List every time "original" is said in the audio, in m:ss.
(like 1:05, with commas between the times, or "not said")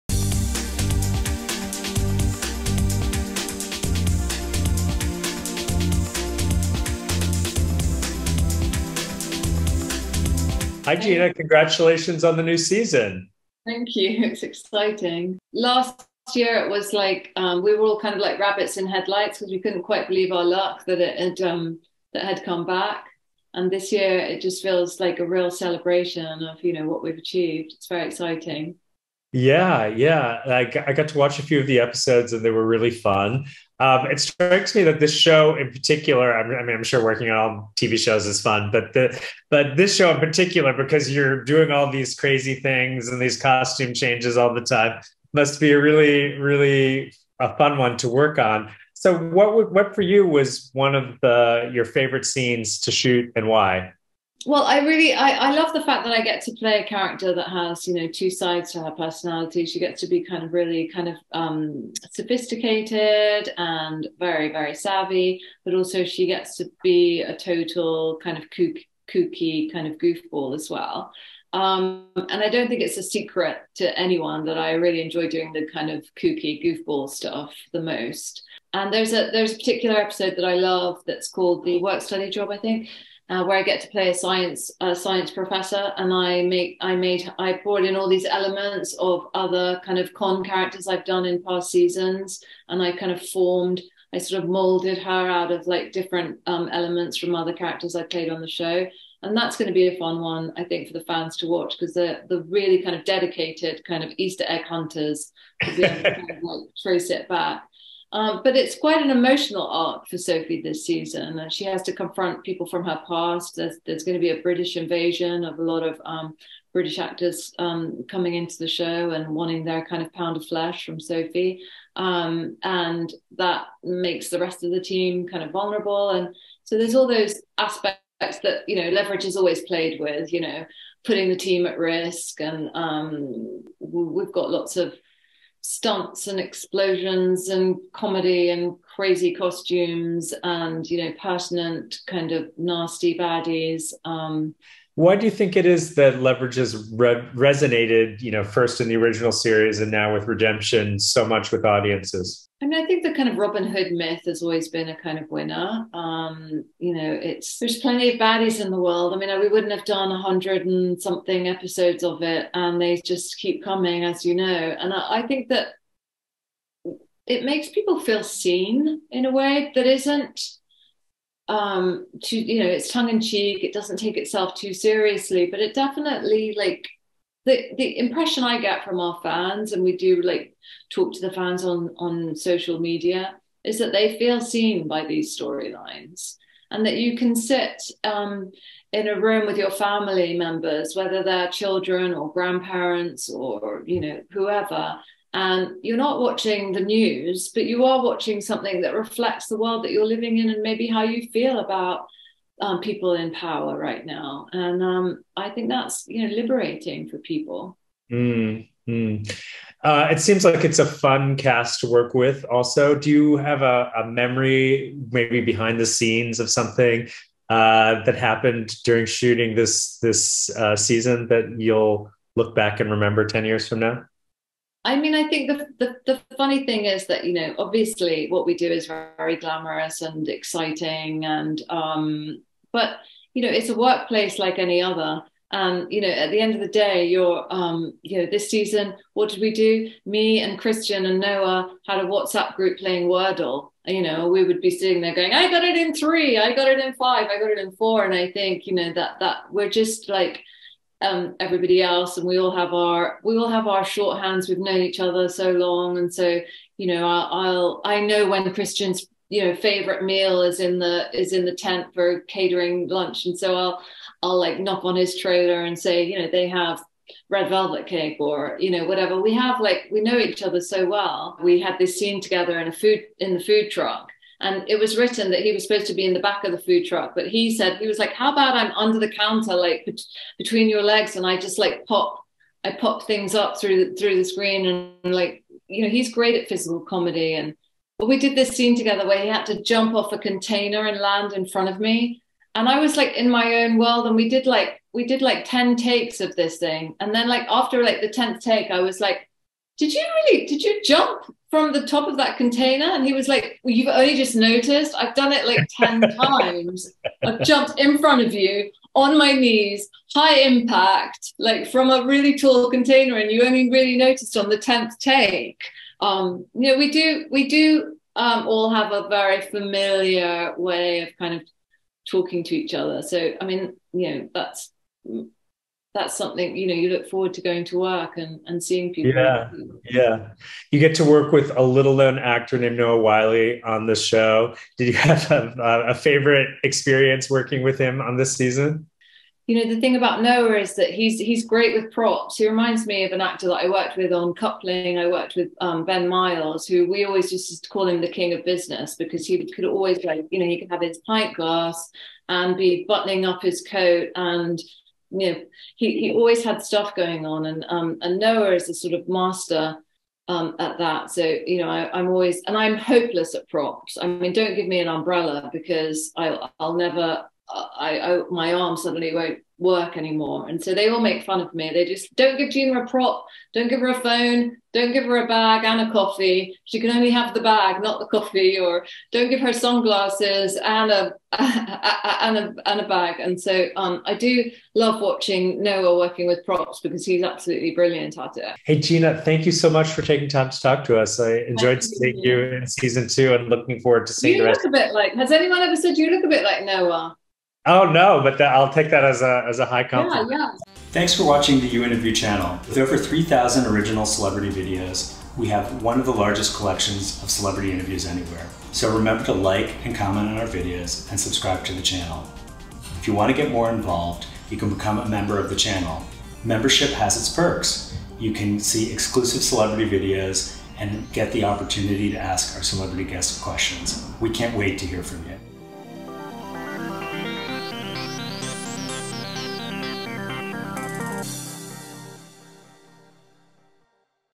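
2:28, 6:43.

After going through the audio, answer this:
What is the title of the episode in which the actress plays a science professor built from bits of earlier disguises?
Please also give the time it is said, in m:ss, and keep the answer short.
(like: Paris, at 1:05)
The Work Study Job, at 1:21.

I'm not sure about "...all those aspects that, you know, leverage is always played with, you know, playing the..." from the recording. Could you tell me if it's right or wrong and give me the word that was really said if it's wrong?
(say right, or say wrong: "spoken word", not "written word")
wrong: "putting", not "playing".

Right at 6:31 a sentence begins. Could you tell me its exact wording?
I enjoyed seeing you in season two and looking forward to seeing you the rest.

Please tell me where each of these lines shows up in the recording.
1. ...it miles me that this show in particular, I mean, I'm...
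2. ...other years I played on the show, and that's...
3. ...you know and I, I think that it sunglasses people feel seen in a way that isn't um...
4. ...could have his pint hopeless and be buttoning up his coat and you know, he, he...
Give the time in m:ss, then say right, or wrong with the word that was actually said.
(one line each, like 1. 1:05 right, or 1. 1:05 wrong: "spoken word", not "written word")
1. 0:34 wrong: "strikes", not "miles"
2. 1:37 wrong: "characters", not "years"
3. 2:44 wrong: "makes", not "sunglasses"
4. 5:50 wrong: "glass", not "hopeless".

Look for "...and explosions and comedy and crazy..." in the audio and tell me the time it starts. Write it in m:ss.
2:16.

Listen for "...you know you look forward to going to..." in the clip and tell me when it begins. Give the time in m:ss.
5:26.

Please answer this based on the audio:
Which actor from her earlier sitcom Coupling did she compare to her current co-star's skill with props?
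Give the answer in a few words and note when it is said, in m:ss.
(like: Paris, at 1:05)
Ben Miles, at 5:45.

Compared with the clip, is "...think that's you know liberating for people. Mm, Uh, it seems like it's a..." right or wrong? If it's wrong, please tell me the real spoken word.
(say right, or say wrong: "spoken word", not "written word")
right.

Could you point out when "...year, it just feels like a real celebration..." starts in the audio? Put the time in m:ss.
0:23.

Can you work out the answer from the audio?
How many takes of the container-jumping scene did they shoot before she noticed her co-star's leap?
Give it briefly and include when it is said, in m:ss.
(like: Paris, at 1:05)
10, at 4:55.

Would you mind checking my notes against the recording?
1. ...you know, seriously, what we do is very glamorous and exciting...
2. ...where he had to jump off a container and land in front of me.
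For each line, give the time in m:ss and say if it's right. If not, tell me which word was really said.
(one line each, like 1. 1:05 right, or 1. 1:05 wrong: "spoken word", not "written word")
1. 3:47 wrong: "obviously", not "seriously"
2. 4:49 right.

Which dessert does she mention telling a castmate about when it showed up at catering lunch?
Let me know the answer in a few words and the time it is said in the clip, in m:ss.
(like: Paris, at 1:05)
Red velvet cake, at 4:27.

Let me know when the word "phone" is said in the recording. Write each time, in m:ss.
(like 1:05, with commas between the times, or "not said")
6:13.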